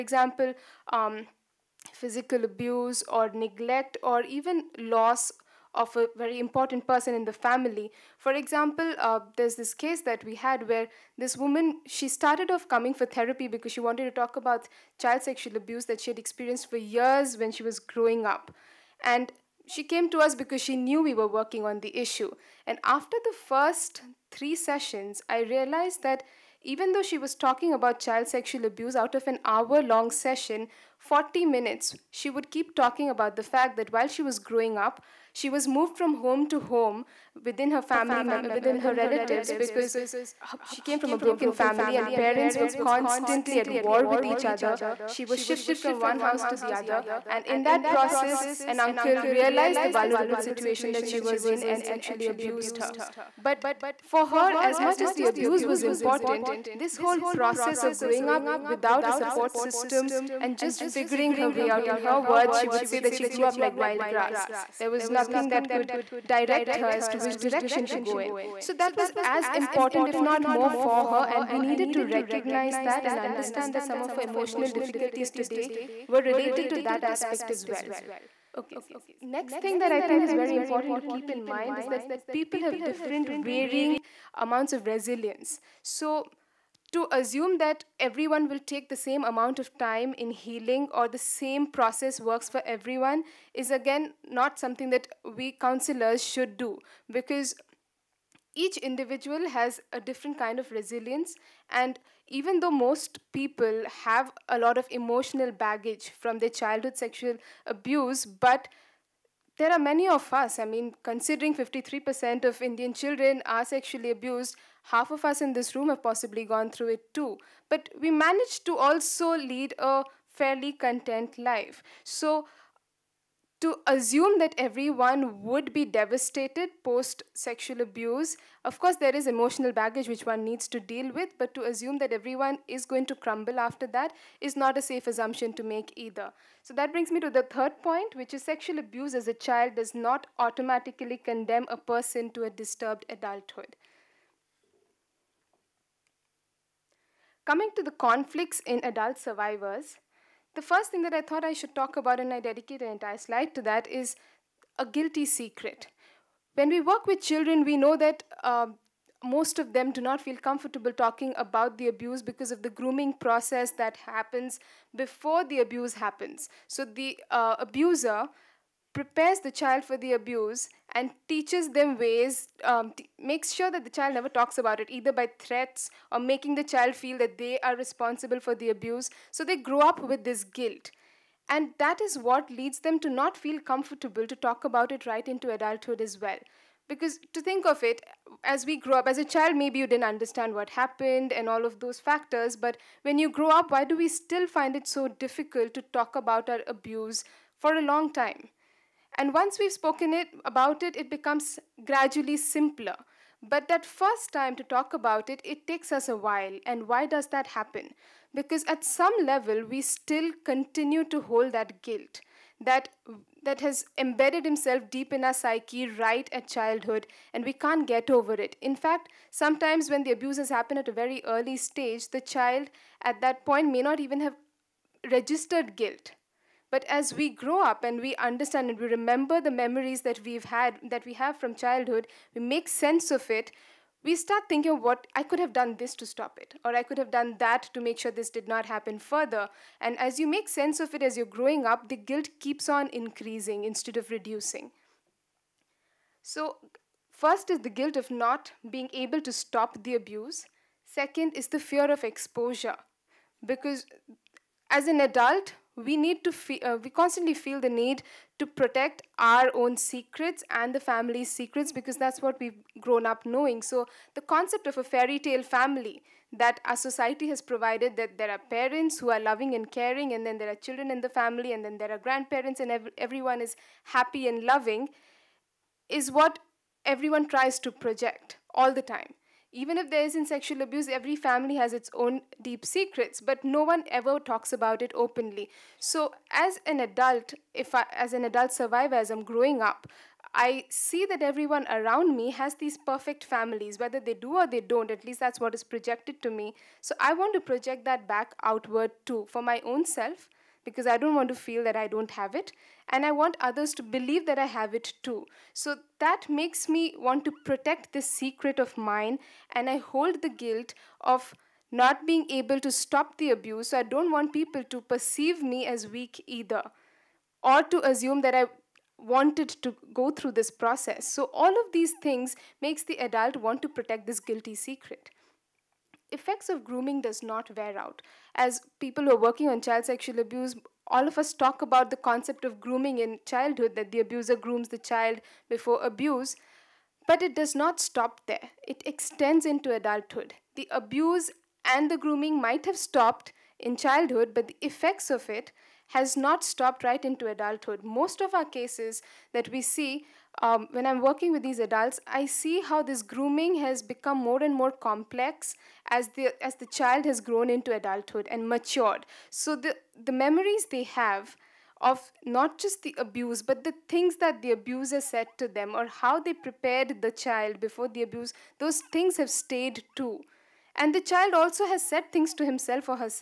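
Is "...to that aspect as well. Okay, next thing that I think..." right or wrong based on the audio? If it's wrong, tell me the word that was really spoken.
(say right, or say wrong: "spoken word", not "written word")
right.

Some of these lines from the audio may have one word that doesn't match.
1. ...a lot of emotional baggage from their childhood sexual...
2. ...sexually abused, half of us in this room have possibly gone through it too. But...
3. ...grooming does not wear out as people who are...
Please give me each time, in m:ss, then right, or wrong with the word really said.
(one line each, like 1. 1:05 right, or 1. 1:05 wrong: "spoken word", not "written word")
1. 1:44 right
2. 1:53 right
3. 5:26 right.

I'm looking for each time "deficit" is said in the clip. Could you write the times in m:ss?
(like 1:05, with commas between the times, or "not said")
not said.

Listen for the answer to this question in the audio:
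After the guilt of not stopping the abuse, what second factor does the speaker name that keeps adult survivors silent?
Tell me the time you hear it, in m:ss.
4:11.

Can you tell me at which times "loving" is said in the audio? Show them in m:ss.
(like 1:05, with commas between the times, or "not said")
4:29, 4:34.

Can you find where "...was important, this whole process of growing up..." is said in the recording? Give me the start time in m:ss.
0:55.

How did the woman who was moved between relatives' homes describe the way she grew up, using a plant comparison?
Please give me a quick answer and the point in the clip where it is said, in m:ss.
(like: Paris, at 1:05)
like wild grass, at 1:03.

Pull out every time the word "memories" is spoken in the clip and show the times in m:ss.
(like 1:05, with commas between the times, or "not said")
3:49, 6:00.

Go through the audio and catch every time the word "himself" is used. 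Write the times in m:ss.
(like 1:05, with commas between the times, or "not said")
3:34, 6:12.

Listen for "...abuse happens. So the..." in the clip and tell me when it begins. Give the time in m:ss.
2:45.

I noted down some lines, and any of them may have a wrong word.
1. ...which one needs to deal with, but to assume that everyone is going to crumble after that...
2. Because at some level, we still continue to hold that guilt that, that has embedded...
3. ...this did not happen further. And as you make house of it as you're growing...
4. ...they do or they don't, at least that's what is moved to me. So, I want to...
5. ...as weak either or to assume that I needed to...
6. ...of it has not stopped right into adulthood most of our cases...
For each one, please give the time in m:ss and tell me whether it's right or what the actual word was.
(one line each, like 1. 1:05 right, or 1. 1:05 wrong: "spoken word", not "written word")
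1. 2:10 right
2. 3:28 right
3. 3:58 wrong: "sense", not "house"
4. 4:54 wrong: "projected", not "moved"
5. 5:15 wrong: "wanted", not "needed"
6. 5:45 right.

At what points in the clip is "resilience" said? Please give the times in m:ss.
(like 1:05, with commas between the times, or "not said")
1:24, 1:40.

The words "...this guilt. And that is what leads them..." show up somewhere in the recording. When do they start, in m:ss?
3:00.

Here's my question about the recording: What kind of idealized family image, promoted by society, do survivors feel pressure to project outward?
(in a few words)
fairy tale family.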